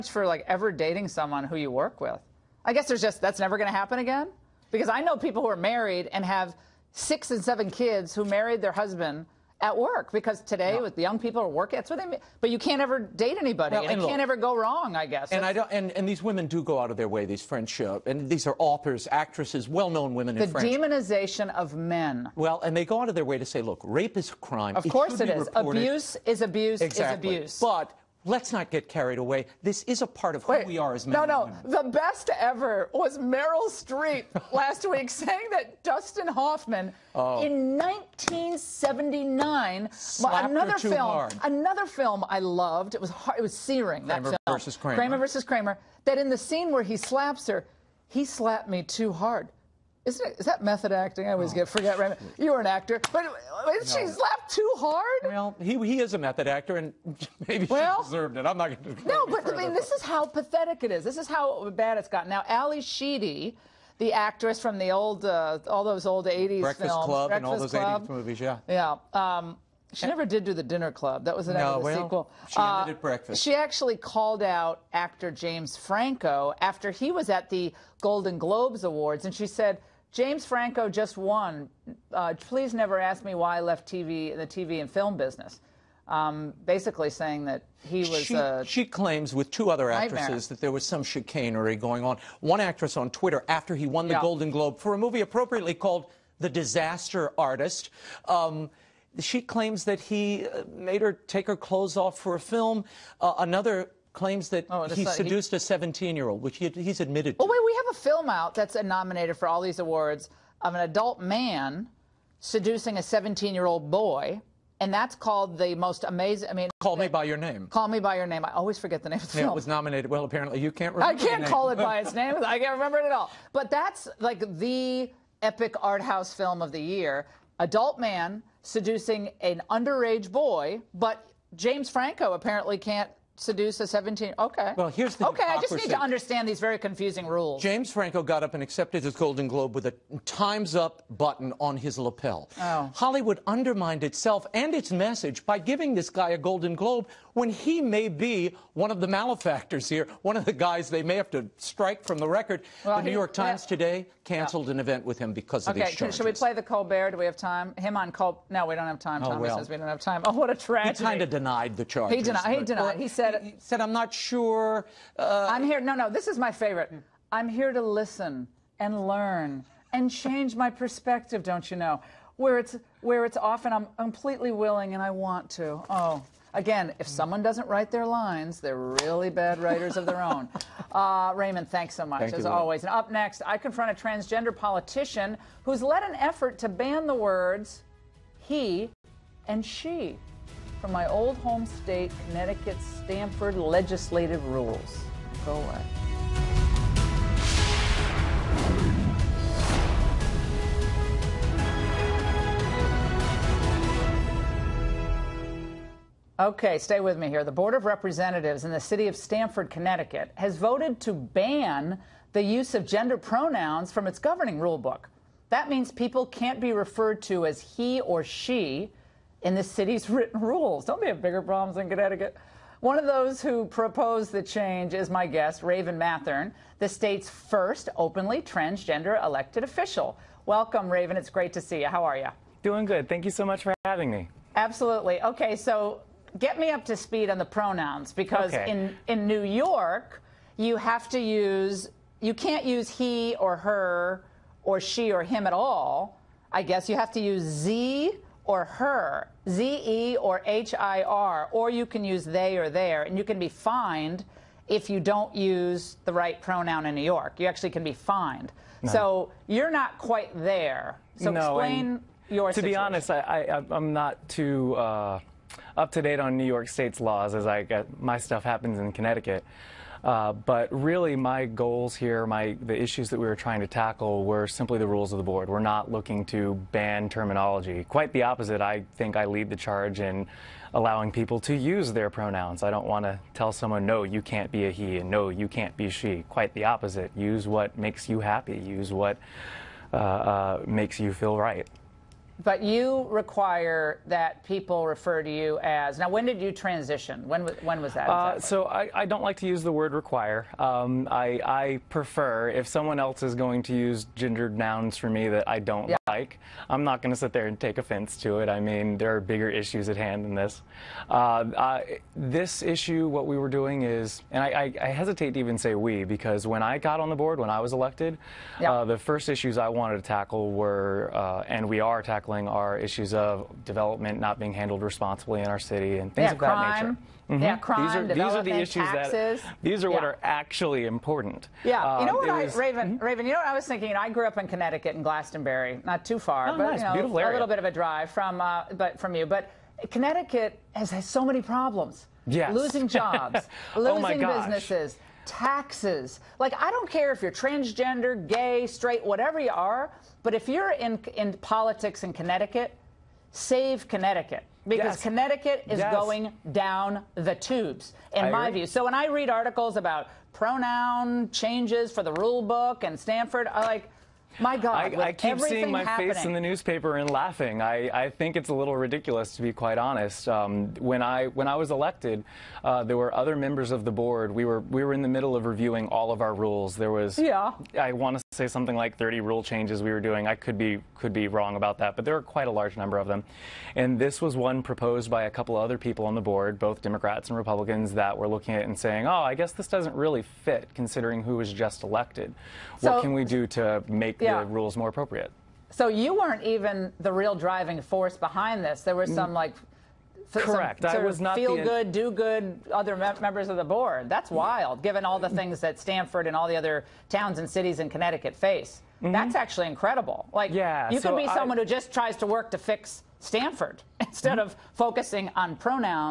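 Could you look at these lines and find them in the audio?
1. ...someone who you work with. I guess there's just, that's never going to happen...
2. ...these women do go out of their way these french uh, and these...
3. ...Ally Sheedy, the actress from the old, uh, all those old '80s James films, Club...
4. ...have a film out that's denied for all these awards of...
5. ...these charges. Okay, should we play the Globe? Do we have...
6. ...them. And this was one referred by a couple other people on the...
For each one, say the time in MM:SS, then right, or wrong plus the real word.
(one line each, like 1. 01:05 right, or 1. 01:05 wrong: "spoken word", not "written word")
1. 00:01 right
2. 00:16 right
3. 01:02 wrong: "Breakfast", not "James"
4. 01:47 wrong: "nominated", not "denied"
5. 02:35 wrong: "Colbert", not "Globe"
6. 06:23 wrong: "proposed", not "referred".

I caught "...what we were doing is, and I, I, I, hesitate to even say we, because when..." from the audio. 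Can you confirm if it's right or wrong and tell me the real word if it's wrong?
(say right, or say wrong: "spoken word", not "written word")
right.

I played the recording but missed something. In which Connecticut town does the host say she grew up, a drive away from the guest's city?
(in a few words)
Glastonbury.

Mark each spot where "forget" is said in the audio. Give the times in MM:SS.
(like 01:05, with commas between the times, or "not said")
00:51, 01:58.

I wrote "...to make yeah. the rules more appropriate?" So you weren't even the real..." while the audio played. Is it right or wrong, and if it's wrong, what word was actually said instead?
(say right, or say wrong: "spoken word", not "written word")
right.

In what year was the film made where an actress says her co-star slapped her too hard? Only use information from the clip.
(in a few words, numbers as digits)
1979.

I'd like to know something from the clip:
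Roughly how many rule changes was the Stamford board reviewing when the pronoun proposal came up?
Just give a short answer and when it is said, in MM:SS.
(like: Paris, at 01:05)
30, at 06:18.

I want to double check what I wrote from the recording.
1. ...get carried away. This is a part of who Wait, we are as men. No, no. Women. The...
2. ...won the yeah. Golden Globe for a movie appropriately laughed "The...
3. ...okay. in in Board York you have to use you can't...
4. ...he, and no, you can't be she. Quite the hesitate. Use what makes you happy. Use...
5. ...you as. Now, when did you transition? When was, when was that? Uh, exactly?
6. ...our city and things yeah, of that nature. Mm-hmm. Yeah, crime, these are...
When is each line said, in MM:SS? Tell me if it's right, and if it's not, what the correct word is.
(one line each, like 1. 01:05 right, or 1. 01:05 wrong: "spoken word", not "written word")
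1. 00:28 right
2. 01:33 wrong: "called", not "laughed"
3. 03:58 wrong: "New", not "Board"
4. 04:44 wrong: "opposite", not "hesitate"
5. 04:55 right
6. 05:25 right.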